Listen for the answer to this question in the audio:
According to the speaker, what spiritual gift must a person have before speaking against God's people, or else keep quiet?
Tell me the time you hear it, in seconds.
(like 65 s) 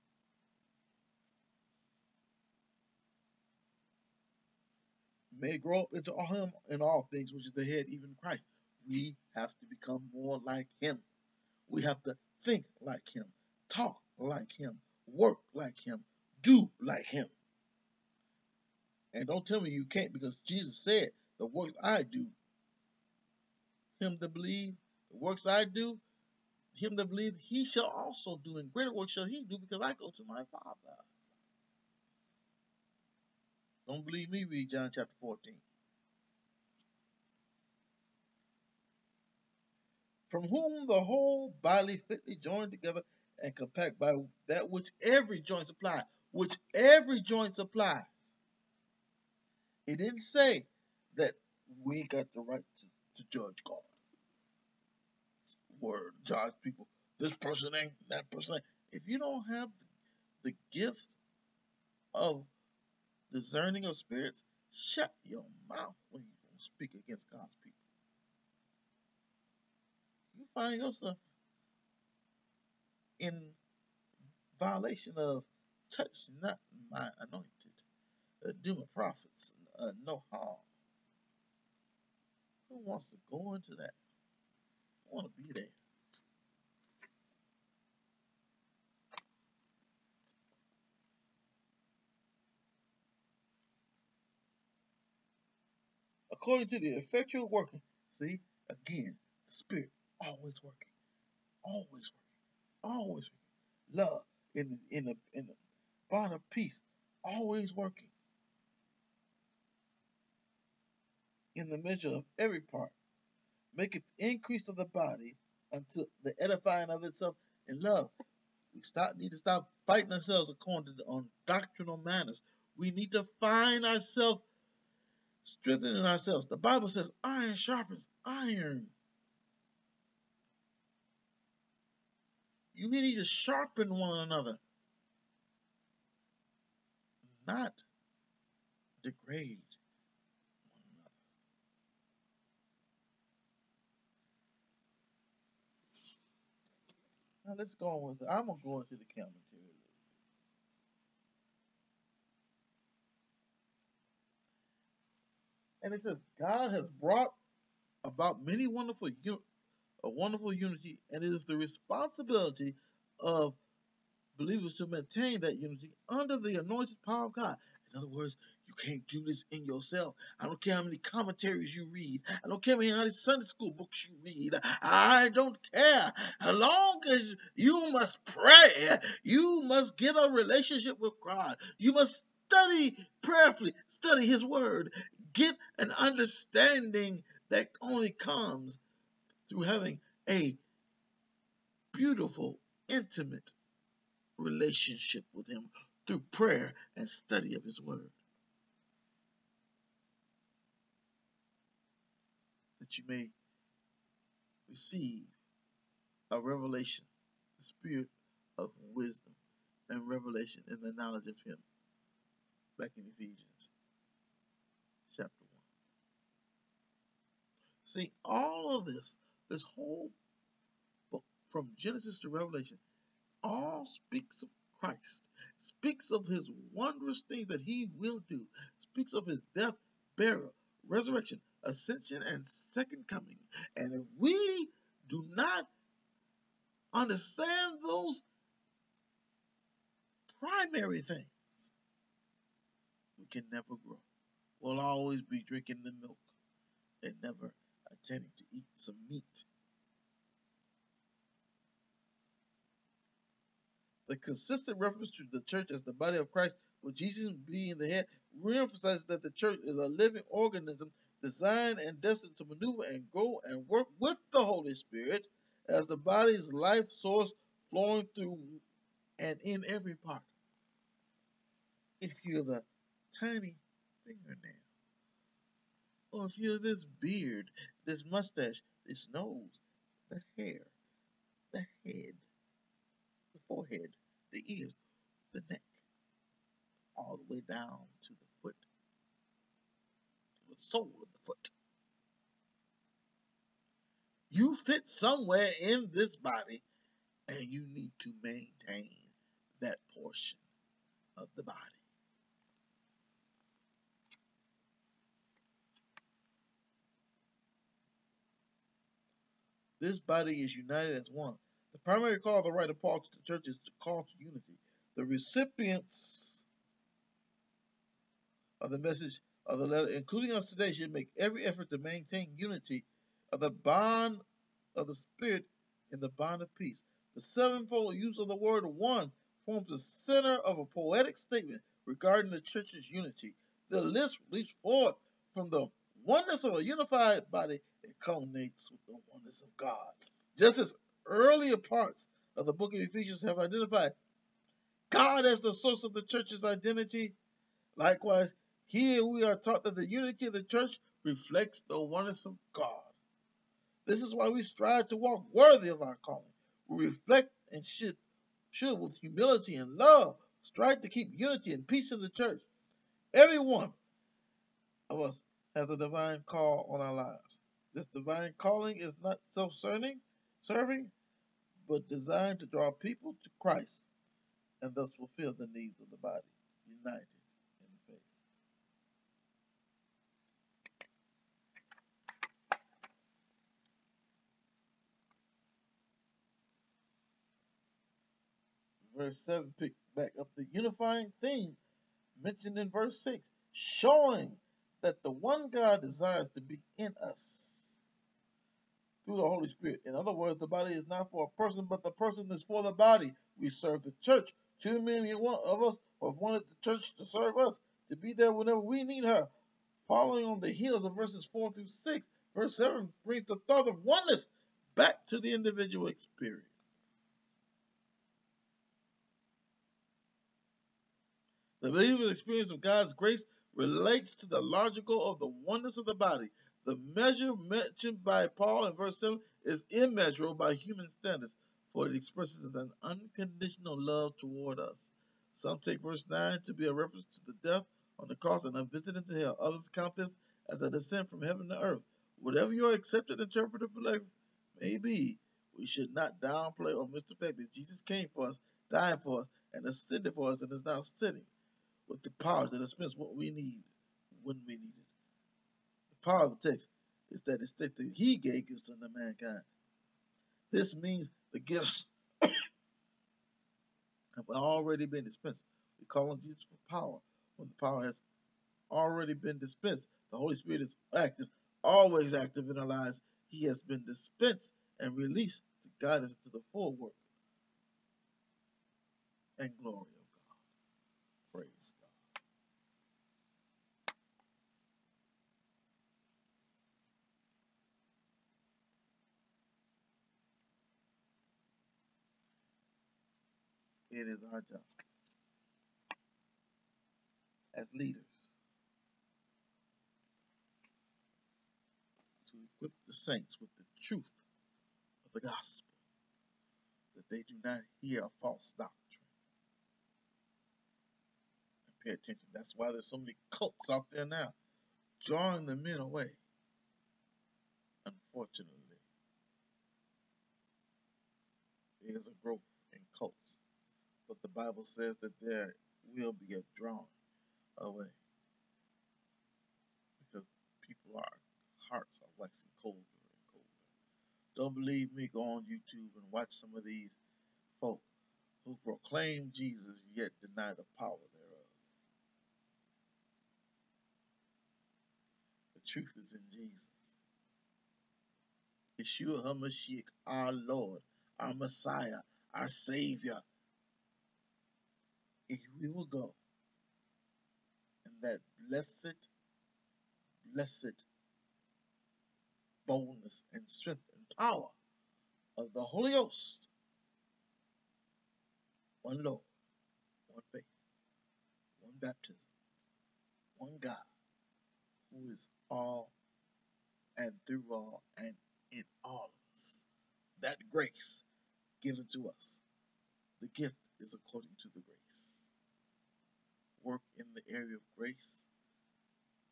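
63 s.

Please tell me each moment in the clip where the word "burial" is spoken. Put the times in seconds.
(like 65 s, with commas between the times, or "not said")
230 s.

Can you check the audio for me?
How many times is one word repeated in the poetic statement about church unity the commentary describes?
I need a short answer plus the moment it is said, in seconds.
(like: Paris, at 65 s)
7, at 327 s.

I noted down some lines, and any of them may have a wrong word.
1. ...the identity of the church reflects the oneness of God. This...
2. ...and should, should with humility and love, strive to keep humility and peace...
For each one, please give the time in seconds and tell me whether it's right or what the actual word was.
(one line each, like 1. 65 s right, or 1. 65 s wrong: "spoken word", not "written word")
1. 349 s wrong: "unity", not "identity"
2. 357 s wrong: "unity", not "humility".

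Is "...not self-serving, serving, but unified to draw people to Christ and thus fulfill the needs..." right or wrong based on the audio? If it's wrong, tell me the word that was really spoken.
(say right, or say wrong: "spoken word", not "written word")
wrong: "designed", not "unified".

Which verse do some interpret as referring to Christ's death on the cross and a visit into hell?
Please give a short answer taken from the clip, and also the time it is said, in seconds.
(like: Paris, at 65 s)
Verse 9, at 435 s.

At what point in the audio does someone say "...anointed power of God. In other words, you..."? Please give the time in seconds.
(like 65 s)
166 s.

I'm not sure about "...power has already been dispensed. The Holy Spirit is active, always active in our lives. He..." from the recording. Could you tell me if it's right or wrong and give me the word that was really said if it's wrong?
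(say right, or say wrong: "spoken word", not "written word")
right.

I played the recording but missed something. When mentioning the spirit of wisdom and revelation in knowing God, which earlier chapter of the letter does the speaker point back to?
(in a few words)
Ephesians chapter 1.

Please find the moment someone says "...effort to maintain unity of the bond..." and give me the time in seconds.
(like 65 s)
321 s.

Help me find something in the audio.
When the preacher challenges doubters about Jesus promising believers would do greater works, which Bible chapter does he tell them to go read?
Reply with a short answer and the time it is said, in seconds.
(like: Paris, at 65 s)
John chapter 14, at 34 s.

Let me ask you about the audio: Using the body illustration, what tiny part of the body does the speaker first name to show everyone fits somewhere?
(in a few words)
fingernail.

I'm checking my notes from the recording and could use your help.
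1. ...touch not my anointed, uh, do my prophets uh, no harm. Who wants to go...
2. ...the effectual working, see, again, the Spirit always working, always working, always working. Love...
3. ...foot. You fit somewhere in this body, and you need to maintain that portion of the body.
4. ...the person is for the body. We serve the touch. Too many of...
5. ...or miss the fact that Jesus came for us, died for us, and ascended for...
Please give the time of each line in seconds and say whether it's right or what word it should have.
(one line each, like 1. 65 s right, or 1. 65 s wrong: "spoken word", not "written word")
1. 75 s right
2. 96 s right
3. 291 s right
4. 401 s wrong: "church", not "touch"
5. 446 s right.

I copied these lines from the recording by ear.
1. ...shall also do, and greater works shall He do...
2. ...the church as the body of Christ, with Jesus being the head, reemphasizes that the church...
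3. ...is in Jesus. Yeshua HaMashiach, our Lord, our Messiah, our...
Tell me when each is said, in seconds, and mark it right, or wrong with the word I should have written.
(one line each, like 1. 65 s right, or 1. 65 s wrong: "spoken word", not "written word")
1. 27 s right
2. 255 s right
3. 546 s right.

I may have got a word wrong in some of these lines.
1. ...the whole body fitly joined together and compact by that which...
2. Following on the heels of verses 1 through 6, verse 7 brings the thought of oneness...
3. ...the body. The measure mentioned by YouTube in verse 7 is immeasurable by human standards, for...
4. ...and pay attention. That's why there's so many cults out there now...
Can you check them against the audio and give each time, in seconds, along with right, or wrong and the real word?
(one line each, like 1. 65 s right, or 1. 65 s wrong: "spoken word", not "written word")
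1. 40 s right
2. 409 s wrong: "4", not "1"
3. 425 s wrong: "Paul", not "YouTube"
4. 511 s right.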